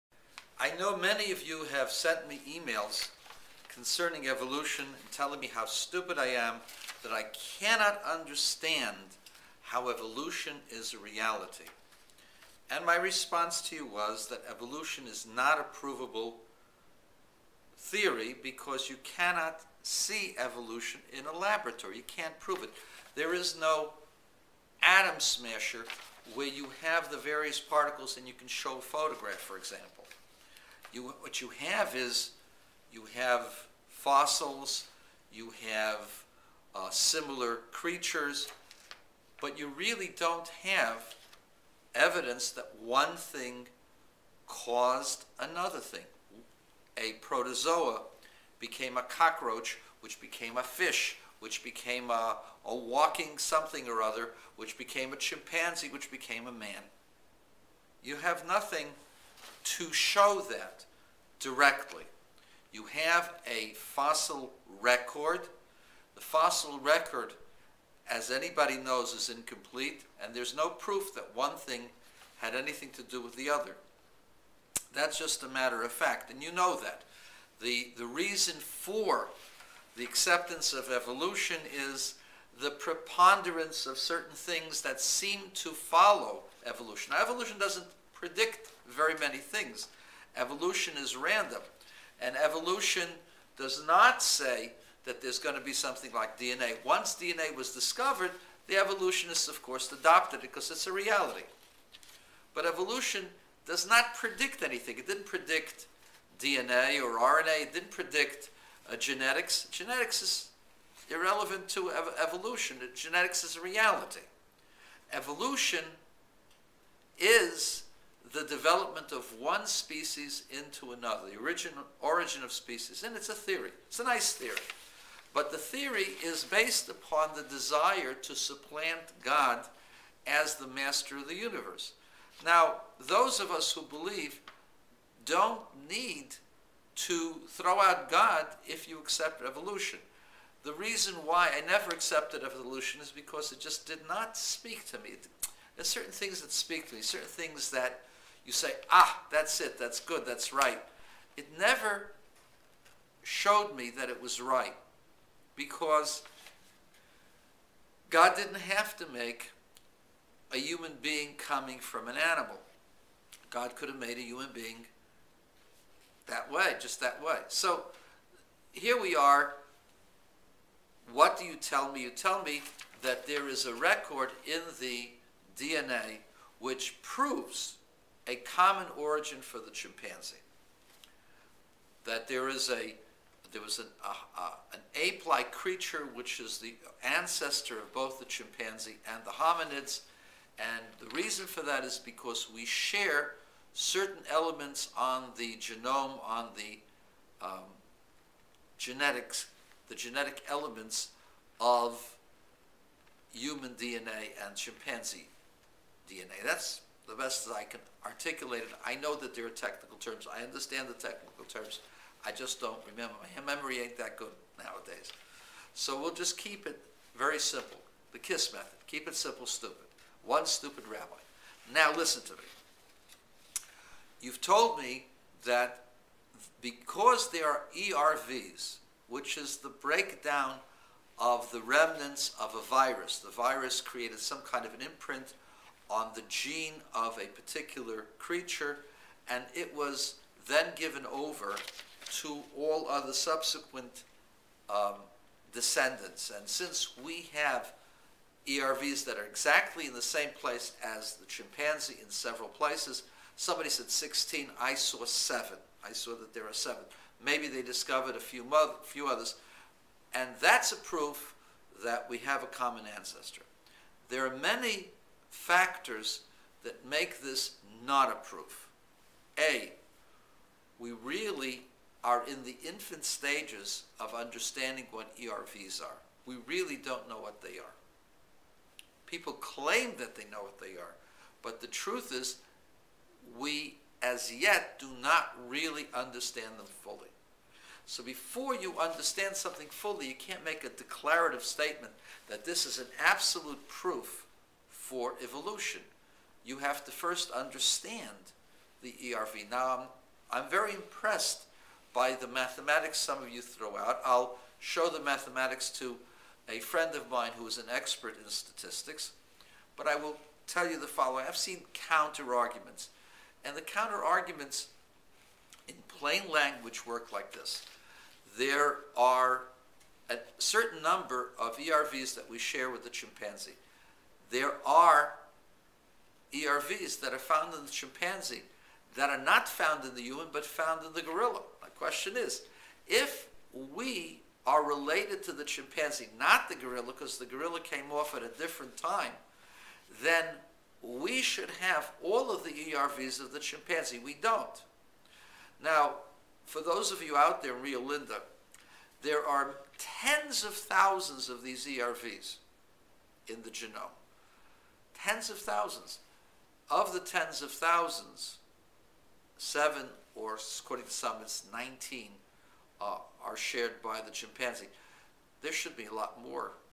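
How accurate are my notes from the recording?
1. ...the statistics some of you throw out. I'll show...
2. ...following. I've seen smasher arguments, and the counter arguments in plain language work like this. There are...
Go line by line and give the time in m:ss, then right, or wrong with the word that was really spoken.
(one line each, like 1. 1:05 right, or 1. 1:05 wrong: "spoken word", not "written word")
1. 5:02 wrong: "mathematics", not "statistics"
2. 5:10 wrong: "counter", not "smasher".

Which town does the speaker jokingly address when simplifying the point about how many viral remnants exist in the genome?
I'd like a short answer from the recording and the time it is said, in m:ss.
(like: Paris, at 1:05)
Rio Linda, at 5:47.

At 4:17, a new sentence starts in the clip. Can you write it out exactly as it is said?
Maybe they discovered a few, mother, few others.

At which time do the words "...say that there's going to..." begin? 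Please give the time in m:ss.
1:34.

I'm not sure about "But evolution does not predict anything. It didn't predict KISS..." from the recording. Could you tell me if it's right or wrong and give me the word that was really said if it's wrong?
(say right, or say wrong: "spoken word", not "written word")
wrong: "DNA", not "KISS".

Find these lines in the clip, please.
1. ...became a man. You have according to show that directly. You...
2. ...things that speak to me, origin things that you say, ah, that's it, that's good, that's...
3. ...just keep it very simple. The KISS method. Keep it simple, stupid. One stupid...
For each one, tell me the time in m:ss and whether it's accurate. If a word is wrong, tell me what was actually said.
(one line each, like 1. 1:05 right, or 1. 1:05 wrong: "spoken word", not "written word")
1. 0:56 wrong: "nothing", not "according"
2. 2:26 wrong: "certain", not "origin"
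3. 3:36 right.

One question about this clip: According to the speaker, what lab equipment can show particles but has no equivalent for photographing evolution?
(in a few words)
atom smasher.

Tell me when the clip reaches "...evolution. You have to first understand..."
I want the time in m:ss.
4:55.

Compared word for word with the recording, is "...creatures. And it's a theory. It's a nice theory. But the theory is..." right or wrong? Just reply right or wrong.
wrong.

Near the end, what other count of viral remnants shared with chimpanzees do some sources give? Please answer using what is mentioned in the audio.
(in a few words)
19.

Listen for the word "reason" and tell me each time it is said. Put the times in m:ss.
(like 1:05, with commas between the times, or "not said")
1:18, 2:20, 3:11.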